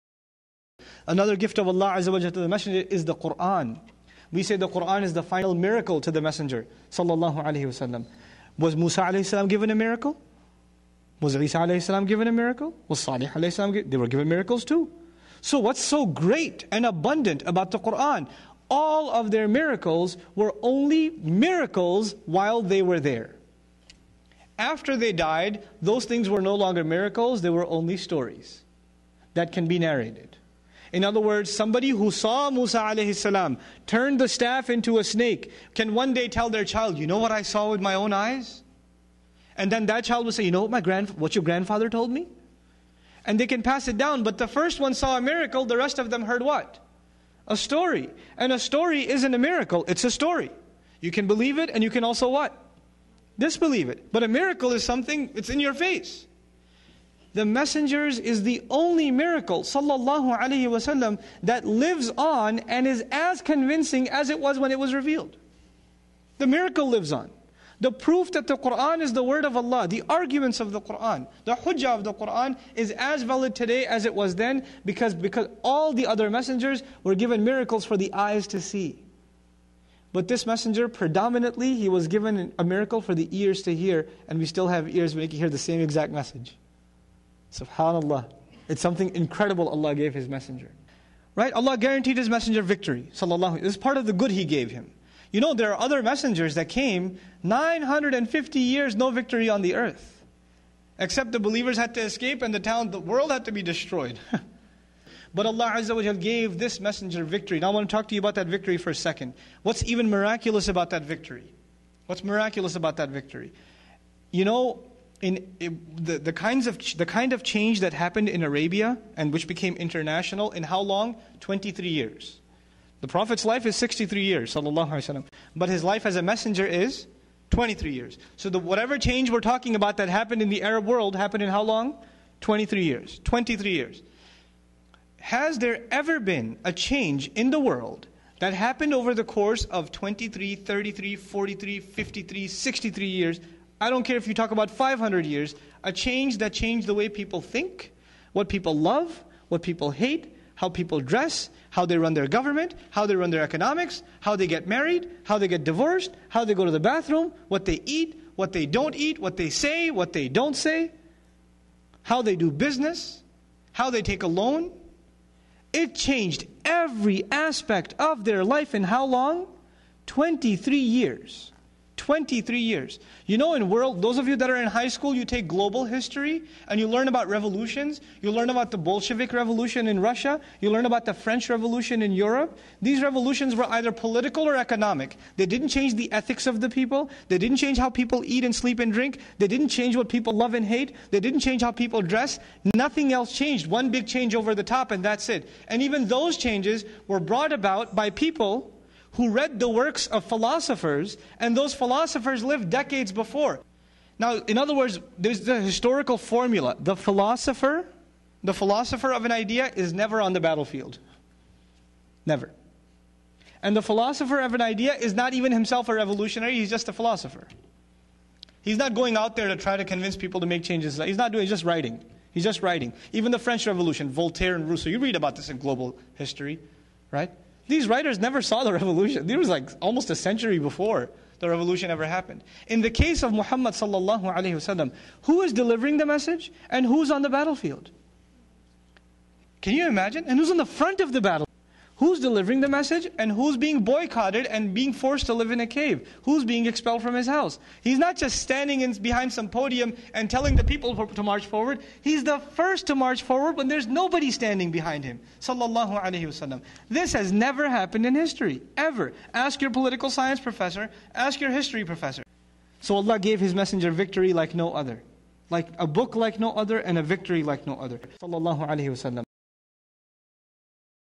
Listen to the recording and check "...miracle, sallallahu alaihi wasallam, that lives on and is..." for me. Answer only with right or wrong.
right.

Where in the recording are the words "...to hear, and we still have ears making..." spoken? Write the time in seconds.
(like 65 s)
83 s.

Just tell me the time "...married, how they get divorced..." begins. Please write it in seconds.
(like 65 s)
154 s.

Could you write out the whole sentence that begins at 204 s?
Now, in other words, there's the historical formula.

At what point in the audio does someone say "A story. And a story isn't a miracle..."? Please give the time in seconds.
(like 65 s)
47 s.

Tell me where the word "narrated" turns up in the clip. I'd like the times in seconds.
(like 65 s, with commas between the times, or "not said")
29 s.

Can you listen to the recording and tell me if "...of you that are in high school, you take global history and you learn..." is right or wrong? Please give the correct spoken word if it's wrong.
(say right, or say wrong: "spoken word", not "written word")
right.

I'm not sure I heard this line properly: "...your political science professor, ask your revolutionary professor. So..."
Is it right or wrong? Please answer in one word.
wrong.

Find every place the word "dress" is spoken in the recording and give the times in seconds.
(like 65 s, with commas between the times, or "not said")
150 s, 192 s.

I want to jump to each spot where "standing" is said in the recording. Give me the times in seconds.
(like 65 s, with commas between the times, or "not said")
248 s, 254 s.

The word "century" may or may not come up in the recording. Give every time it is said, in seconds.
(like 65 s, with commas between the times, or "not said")
230 s.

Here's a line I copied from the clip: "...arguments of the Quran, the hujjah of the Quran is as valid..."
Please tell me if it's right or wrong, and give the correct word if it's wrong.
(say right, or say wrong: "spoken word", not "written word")
right.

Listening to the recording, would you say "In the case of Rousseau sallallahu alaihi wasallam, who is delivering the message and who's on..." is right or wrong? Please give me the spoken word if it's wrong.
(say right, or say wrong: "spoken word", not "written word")
wrong: "Muhammad", not "Rousseau".